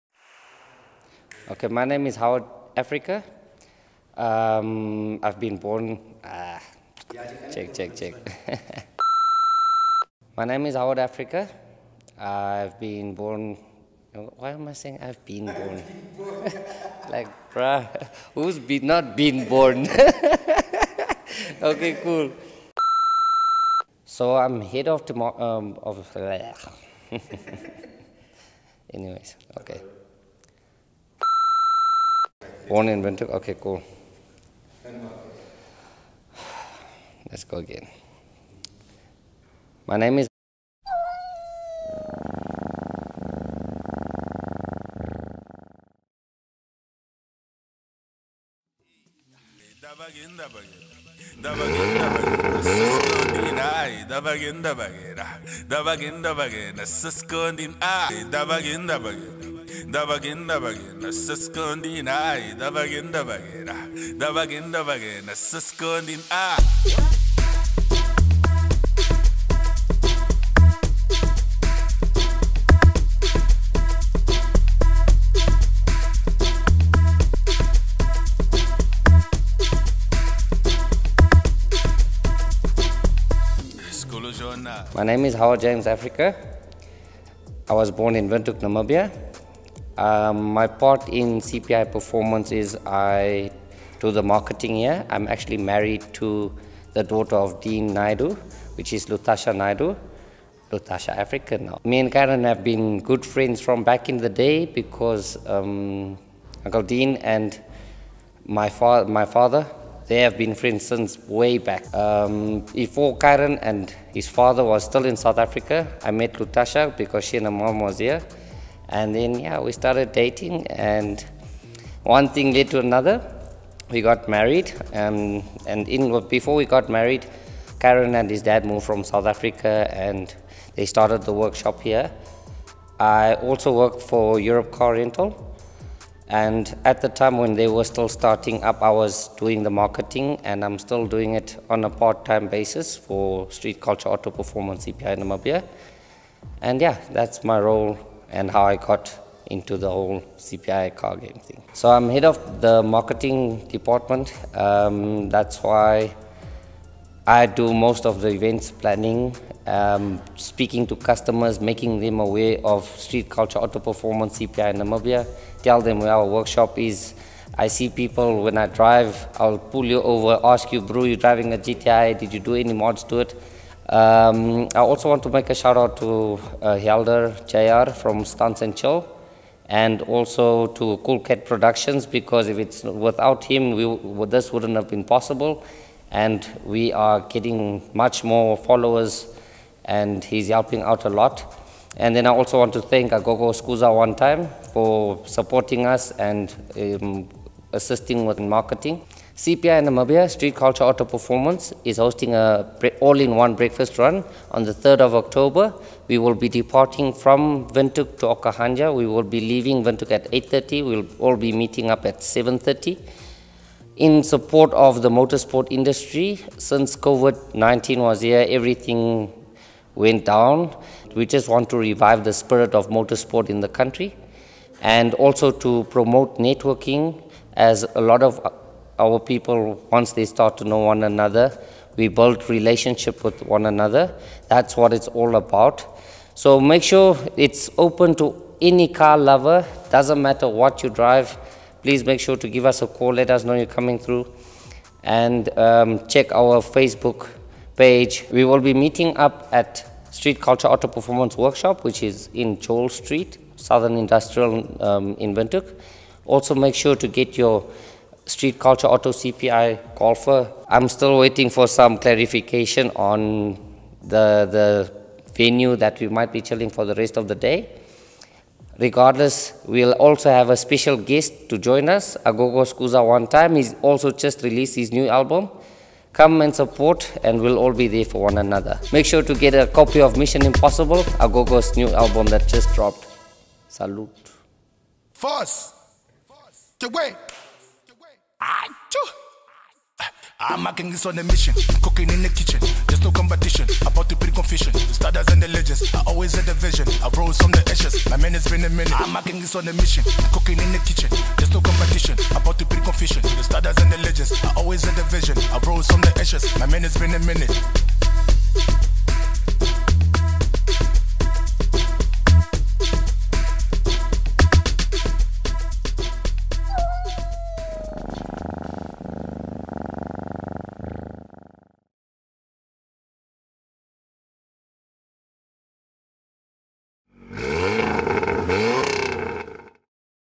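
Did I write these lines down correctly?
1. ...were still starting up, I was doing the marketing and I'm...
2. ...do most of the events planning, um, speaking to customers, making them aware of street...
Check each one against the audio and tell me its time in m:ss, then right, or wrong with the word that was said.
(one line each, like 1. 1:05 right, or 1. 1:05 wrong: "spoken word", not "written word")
1. 2:17 right
2. 2:37 right.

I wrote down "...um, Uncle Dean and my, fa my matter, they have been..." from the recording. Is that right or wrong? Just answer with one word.
wrong.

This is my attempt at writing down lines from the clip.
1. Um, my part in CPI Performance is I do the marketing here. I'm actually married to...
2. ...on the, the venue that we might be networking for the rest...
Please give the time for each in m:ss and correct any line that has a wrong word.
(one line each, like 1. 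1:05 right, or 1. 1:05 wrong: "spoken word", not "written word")
1. 1:30 right
2. 4:22 wrong: "chilling", not "networking".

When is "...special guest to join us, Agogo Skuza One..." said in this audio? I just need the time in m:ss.
4:30.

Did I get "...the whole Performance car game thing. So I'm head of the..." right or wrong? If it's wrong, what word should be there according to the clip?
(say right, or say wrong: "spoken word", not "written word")
wrong: "CPI", not "Performance".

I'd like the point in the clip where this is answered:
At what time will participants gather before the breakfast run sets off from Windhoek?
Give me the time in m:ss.
3:32.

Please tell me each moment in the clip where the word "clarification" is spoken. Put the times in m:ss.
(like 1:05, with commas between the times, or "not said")
4:21.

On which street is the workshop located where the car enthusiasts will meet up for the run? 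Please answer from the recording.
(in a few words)
Joel Street.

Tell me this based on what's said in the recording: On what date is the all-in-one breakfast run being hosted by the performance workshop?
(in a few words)
3rd of October.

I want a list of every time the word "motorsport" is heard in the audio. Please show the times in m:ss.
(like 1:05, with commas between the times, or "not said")
3:35, 3:42.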